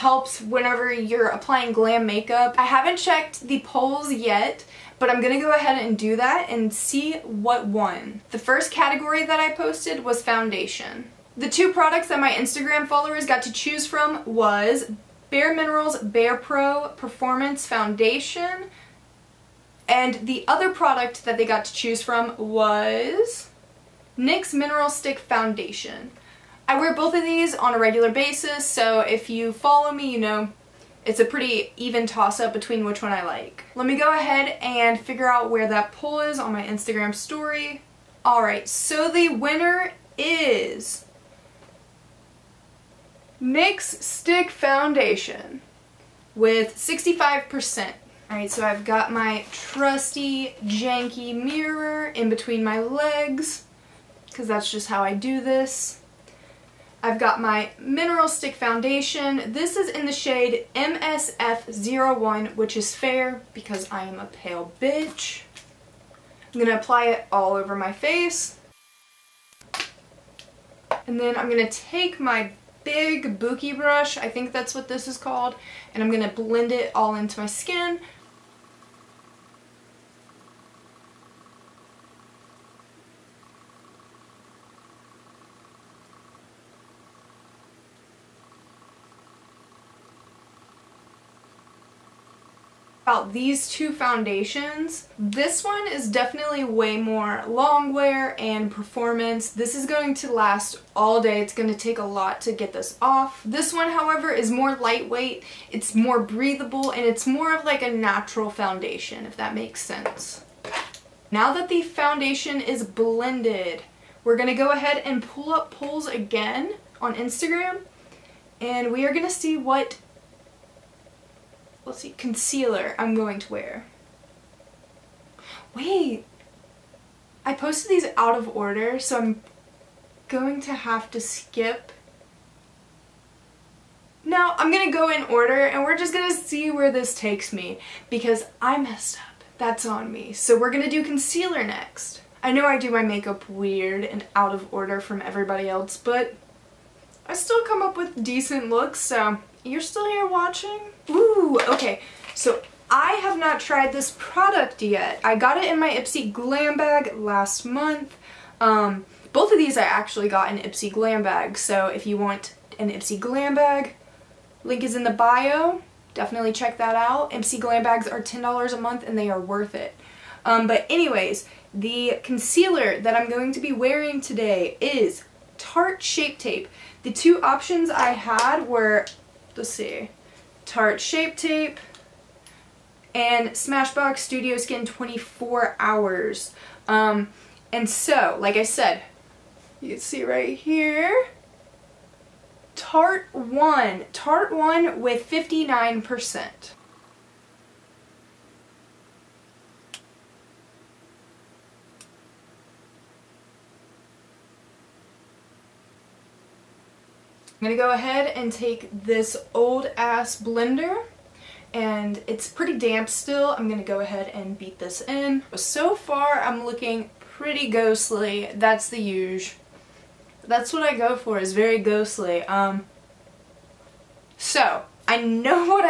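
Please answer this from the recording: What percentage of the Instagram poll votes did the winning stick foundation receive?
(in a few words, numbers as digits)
65%.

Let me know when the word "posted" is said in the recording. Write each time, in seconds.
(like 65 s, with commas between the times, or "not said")
9 s, 127 s.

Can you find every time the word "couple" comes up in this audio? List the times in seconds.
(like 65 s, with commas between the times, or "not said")
not said.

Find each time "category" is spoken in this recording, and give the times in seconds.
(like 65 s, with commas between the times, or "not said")
8 s.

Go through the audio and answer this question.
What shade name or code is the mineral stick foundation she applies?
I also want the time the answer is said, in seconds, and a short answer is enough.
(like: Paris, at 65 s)
MSF01, at 60 s.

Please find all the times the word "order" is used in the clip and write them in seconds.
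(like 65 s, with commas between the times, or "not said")
128 s, 135 s, 144 s.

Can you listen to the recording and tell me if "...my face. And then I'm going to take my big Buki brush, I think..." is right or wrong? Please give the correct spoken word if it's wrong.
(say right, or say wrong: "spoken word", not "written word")
right.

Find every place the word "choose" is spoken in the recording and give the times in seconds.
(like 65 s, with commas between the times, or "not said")
13 s, 21 s.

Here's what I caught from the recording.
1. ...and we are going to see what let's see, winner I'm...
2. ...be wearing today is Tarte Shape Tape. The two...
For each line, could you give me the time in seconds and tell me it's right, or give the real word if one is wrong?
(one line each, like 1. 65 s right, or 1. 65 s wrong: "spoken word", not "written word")
1. 118 s wrong: "concealer", not "winner"
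2. 173 s right.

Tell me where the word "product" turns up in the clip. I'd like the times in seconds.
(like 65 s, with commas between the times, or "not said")
11 s, 20 s, 154 s.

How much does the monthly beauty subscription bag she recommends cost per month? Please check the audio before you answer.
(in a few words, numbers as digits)
$10.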